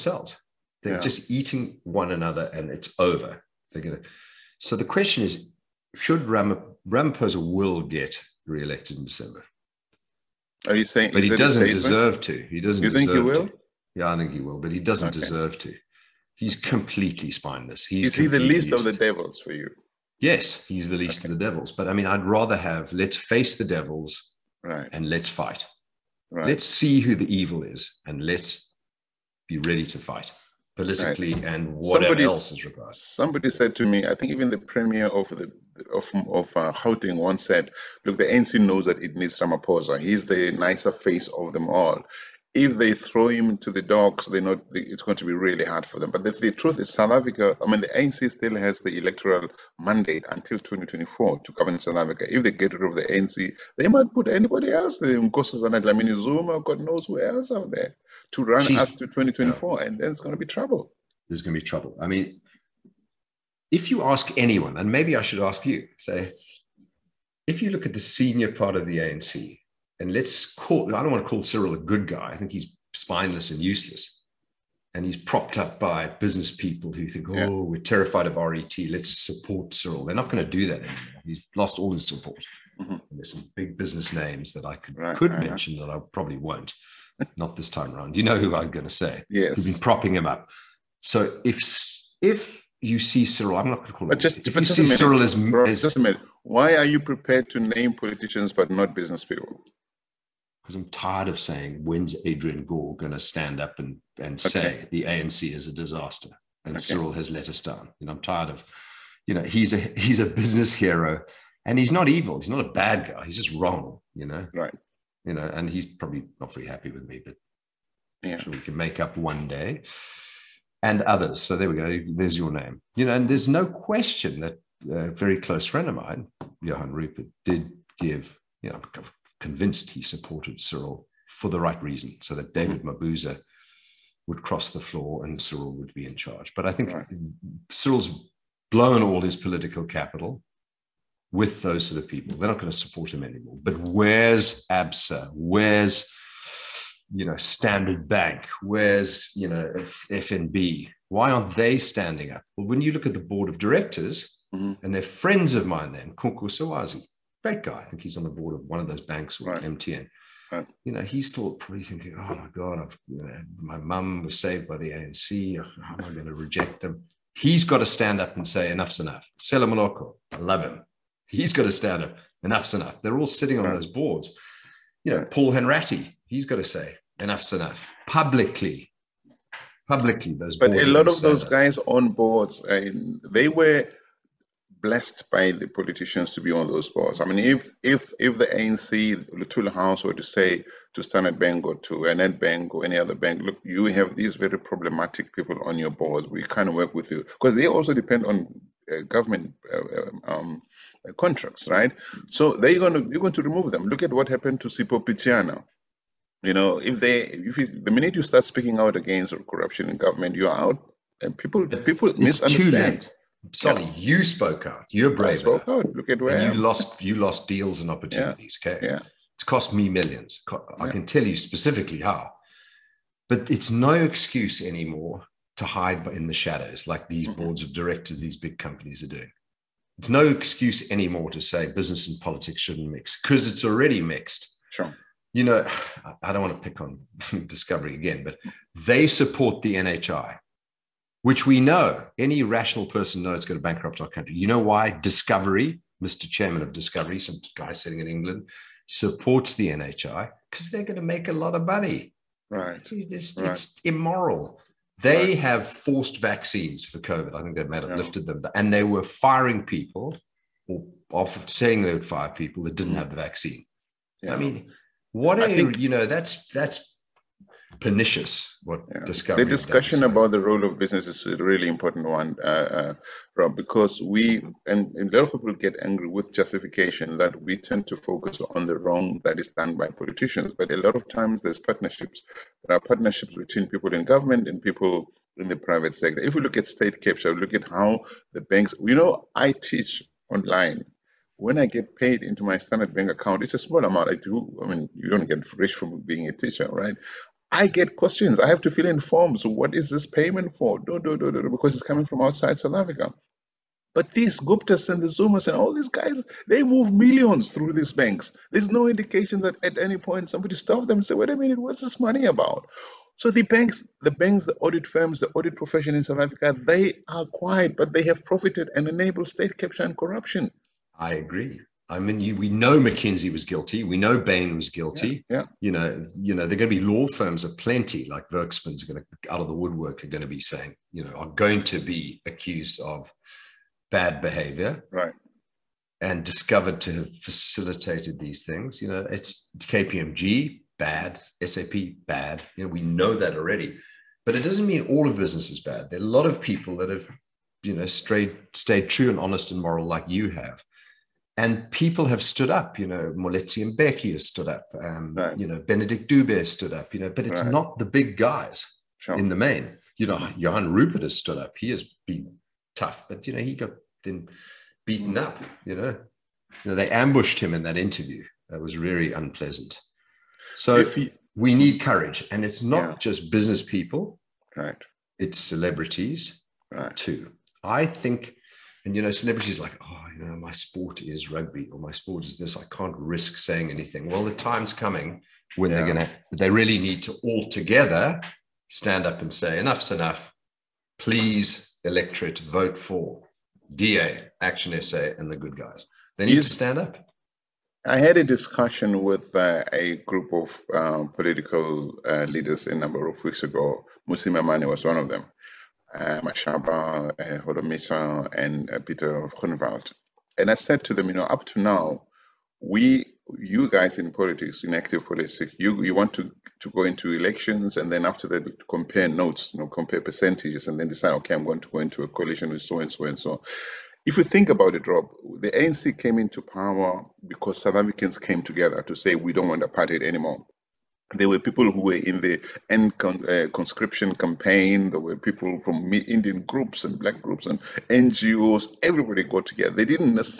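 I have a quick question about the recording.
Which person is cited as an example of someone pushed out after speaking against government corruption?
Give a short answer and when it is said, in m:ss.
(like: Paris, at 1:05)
Sipho Pityana, at 3:24.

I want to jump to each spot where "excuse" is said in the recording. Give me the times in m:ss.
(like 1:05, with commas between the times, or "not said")
3:43, 3:50.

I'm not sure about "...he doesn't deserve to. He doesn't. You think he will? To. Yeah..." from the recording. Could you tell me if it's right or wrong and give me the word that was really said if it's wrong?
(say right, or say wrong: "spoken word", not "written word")
right.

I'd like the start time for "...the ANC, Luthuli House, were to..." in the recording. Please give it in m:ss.
3:08.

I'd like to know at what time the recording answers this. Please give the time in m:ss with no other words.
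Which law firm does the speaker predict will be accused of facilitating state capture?
5:28.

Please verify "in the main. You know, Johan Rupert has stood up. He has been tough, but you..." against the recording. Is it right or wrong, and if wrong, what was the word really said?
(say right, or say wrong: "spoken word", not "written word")
right.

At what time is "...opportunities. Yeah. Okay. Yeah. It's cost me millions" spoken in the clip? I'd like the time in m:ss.
3:37.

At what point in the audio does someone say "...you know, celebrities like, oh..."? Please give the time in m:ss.
6:18.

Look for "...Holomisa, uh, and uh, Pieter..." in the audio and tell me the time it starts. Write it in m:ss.
6:47.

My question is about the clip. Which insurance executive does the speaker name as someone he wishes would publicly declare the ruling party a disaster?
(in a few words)
Adrian Gore.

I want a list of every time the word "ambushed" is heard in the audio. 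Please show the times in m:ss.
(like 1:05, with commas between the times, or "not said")
6:06.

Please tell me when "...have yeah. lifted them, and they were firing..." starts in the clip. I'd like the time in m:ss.
4:17.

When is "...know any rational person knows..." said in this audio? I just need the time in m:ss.
4:01.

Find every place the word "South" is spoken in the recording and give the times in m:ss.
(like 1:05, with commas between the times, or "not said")
0:46, 0:51, 5:02, 5:16, 7:07.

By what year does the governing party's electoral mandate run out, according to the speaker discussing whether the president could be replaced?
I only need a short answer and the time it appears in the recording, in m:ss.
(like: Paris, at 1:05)
2024, at 0:50.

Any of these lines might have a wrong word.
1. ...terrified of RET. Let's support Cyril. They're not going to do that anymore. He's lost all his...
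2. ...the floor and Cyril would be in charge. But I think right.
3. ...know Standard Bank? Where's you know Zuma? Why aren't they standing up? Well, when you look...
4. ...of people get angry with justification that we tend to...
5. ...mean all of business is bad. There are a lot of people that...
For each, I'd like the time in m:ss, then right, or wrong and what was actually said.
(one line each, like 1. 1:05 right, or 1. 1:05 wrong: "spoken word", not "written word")
1. 1:17 right
2. 2:14 right
3. 2:27 wrong: "FNB", not "Zuma"
4. 4:35 right
5. 5:44 right.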